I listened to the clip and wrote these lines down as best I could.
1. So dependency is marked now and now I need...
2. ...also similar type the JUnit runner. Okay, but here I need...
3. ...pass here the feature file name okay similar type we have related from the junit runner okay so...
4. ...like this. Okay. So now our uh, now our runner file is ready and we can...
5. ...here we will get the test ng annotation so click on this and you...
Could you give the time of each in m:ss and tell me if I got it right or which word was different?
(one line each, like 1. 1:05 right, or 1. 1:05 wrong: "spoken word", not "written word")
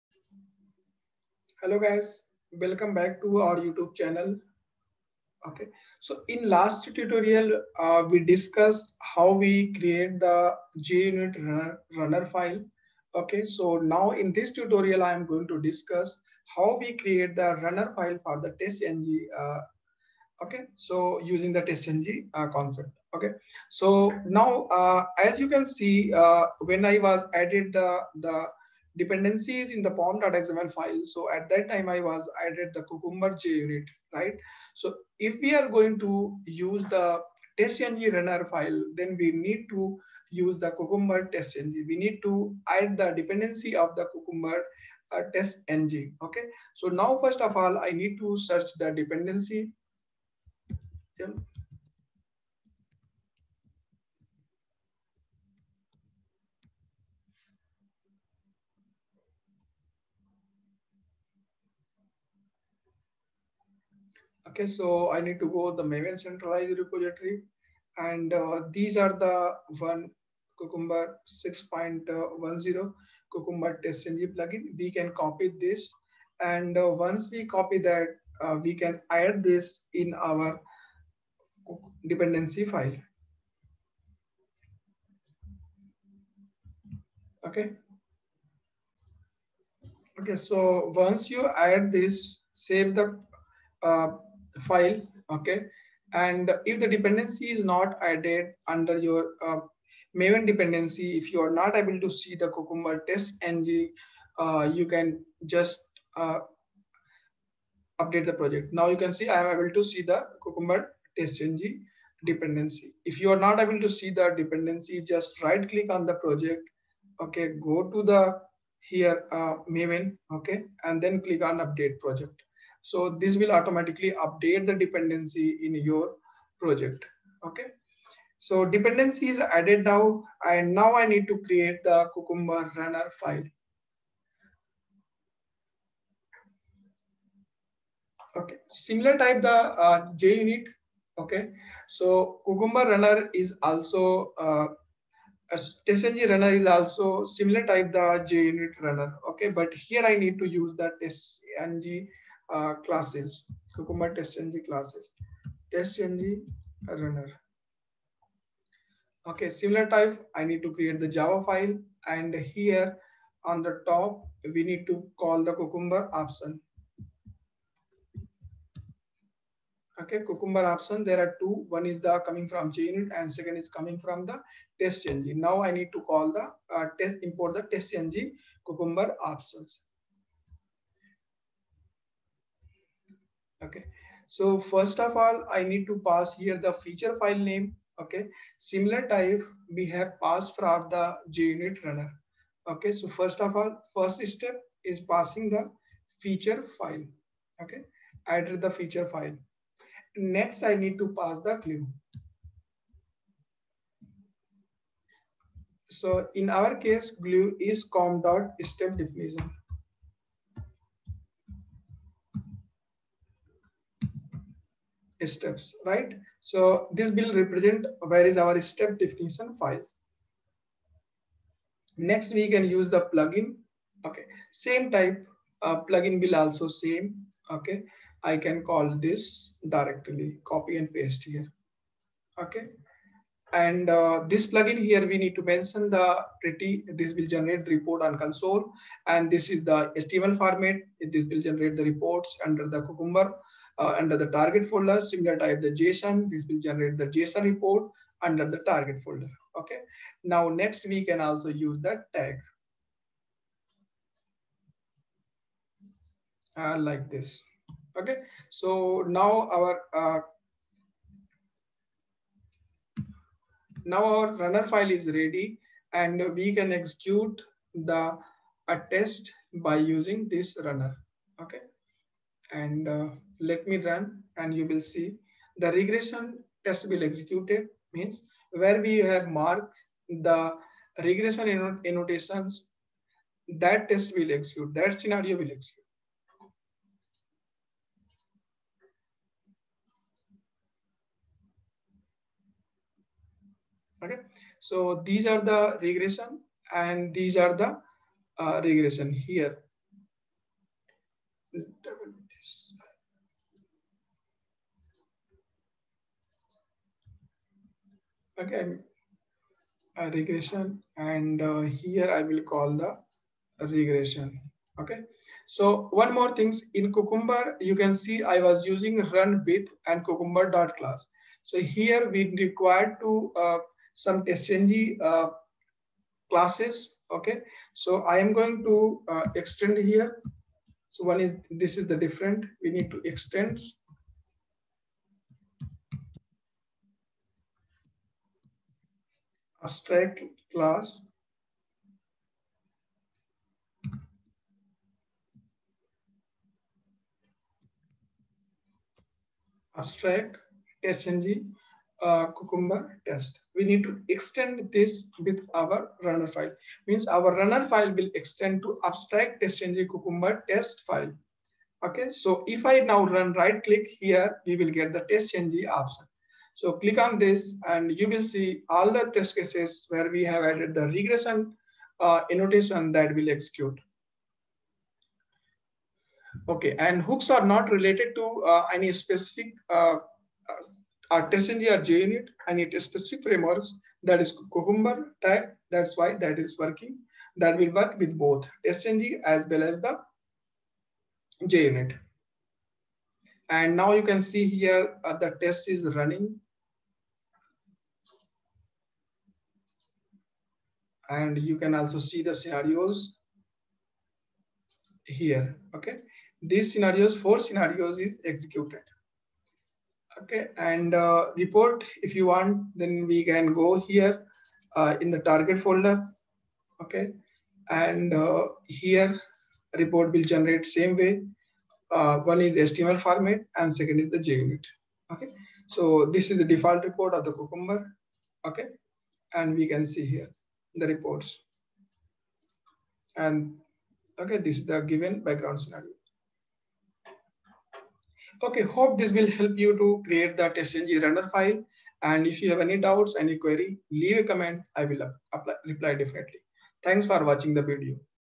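1. 2:08 wrong: "added", not "marked"
2. 2:26 right
3. 3:06 wrong: "passed", not "related"
4. 4:16 right
5. 6:03 wrong: "option", not "annotation".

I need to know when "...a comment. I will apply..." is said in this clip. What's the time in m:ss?
7:24.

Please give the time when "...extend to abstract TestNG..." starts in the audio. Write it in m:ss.
5:58.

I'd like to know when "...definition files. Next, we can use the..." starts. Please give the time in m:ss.
3:38.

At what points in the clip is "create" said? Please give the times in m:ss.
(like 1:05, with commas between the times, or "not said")
0:09, 0:16, 2:11, 2:40, 7:20.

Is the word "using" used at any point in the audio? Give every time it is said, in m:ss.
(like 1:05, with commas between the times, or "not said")
0:21, 4:29, 5:18.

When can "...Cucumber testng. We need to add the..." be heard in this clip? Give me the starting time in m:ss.
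0:40.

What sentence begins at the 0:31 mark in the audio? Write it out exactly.
So at that time I was added the Cucumber JUnit, right?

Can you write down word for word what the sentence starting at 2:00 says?
Okay, and then click on update project.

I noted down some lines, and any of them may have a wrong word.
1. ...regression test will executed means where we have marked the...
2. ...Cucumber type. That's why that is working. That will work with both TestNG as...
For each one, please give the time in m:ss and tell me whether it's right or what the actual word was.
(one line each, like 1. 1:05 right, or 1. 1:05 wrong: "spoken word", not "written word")
1. 4:35 right
2. 6:24 right.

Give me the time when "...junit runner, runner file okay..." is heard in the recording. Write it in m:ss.
0:10.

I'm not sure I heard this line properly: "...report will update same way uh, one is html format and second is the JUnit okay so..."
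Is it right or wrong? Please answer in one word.
wrong.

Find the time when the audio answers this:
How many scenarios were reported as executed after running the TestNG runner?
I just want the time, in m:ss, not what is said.
6:47.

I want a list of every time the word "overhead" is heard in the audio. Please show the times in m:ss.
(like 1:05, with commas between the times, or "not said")
not said.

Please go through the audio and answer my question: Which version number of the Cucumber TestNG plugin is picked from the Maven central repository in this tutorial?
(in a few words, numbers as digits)
6.10.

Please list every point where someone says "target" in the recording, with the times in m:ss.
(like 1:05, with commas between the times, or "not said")
4:04, 4:08, 6:55.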